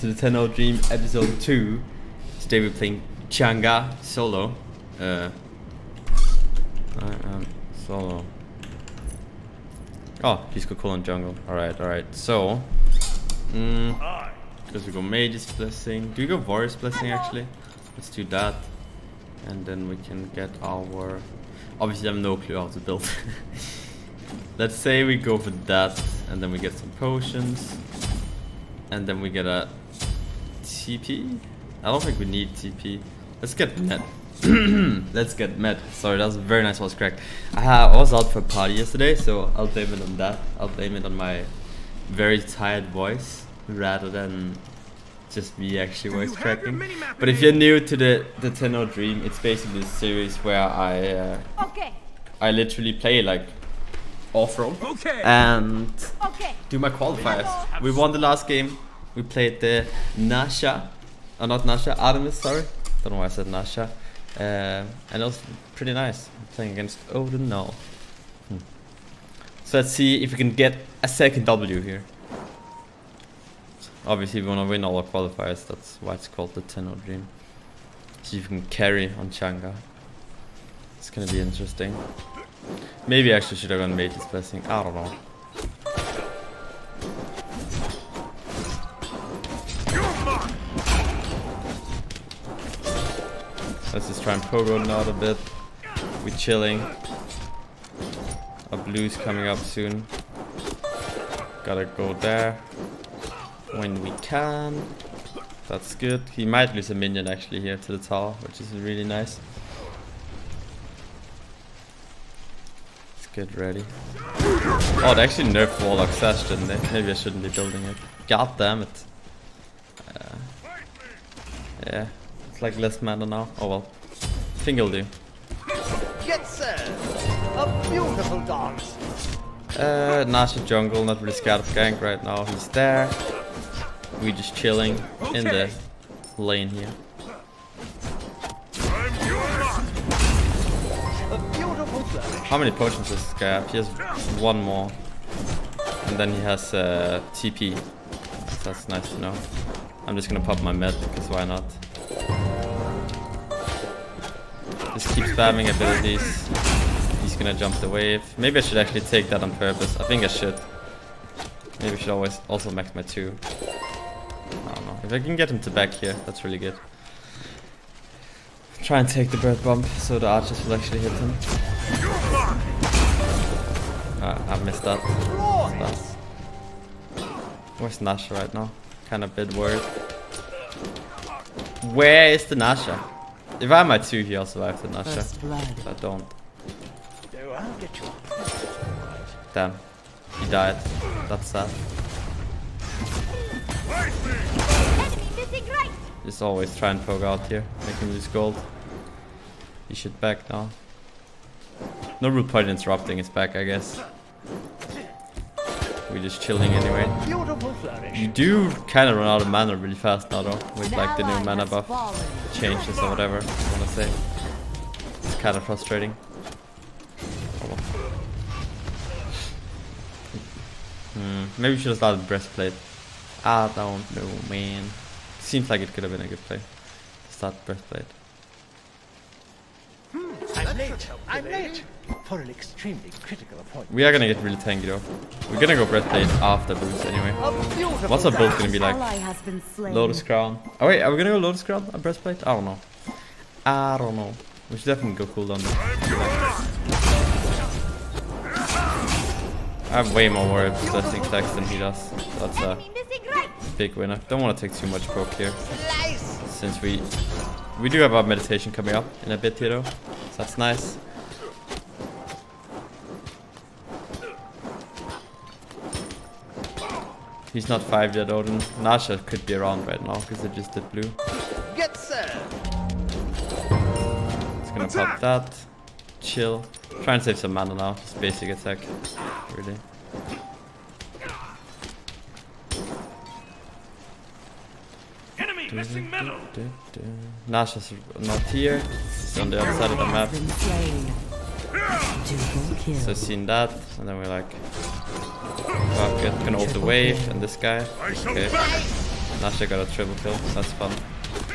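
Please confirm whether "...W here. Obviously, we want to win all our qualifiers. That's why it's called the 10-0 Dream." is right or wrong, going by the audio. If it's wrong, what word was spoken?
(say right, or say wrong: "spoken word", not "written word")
right.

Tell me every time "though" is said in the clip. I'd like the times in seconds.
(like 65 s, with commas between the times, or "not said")
210 s, 234 s, 259 s.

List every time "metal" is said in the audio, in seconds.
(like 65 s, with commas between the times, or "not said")
286 s.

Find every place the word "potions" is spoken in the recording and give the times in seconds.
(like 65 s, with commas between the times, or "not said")
26 s, 142 s.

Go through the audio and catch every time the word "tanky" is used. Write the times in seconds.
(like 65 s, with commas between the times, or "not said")
234 s.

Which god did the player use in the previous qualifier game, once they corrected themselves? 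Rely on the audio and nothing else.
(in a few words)
Artemis.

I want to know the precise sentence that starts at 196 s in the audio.
Just always try and poke out here.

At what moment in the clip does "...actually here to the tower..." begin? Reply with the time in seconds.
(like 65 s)
107 s.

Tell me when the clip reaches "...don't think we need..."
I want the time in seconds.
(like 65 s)
31 s.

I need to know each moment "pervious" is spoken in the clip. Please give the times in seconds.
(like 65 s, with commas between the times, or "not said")
not said.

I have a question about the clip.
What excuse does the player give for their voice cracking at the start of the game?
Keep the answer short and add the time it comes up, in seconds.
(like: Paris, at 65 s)
A party yesterday, at 37 s.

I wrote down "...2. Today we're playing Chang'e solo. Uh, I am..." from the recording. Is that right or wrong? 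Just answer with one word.
right.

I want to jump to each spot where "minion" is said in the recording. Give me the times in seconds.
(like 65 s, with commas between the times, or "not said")
106 s.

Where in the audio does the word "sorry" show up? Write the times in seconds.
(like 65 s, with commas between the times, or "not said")
35 s, 62 s.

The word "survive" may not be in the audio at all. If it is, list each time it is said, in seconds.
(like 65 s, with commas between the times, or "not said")
184 s.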